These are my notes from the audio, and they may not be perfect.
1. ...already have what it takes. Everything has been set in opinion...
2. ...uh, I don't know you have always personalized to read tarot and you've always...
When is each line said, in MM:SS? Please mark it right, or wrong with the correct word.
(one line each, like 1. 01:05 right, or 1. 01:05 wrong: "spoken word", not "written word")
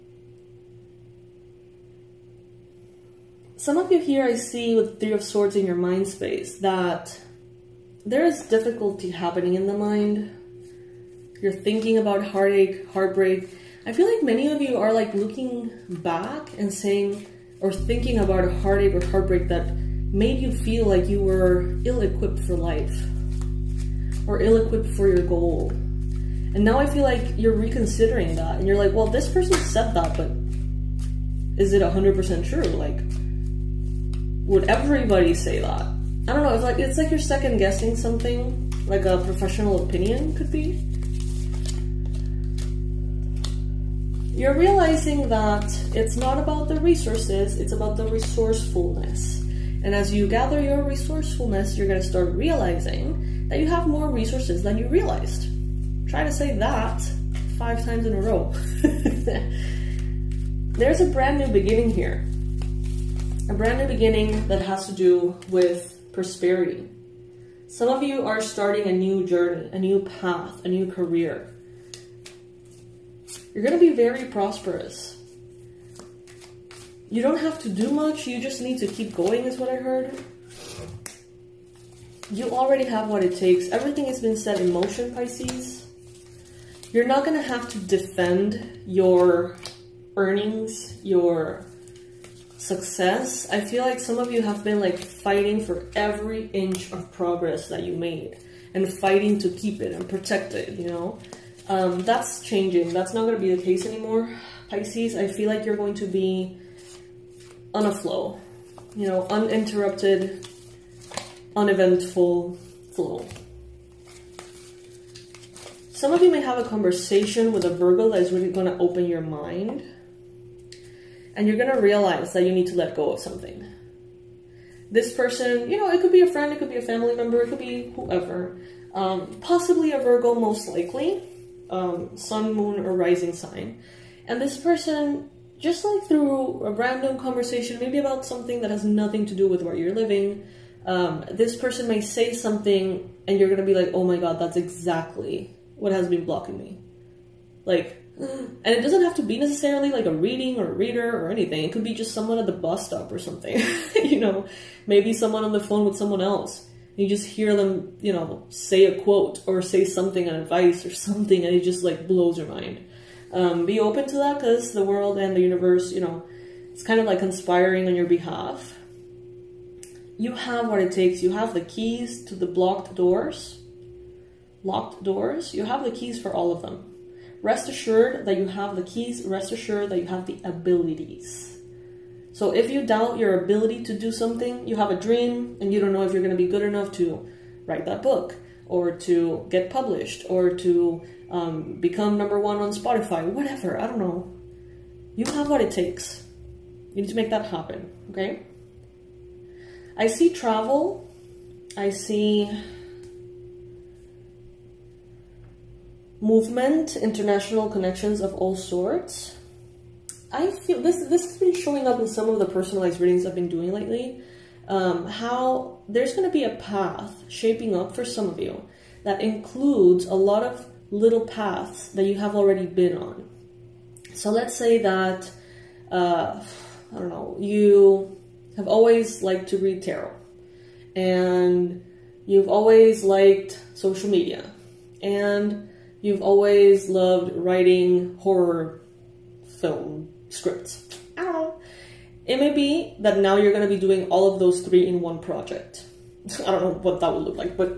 1. 01:22 wrong: "motion", not "opinion"
2. 03:45 wrong: "liked", not "personalized".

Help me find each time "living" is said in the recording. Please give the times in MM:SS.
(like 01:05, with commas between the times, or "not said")
02:19.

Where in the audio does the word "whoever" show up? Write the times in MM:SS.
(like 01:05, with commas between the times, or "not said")
02:07.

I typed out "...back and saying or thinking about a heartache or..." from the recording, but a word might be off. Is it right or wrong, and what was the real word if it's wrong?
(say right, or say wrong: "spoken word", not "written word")
right.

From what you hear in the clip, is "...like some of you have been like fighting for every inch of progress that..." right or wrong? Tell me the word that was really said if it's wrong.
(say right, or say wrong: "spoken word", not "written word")
right.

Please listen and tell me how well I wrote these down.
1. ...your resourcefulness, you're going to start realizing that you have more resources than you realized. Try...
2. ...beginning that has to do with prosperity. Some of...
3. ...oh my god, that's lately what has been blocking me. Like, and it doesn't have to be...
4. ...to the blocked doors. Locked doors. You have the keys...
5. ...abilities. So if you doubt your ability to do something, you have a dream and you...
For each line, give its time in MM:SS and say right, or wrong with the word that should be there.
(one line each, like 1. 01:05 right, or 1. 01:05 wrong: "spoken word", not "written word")
1. 00:50 right
2. 01:03 right
3. 02:23 wrong: "exactly", not "lately"
4. 02:52 right
5. 03:00 right.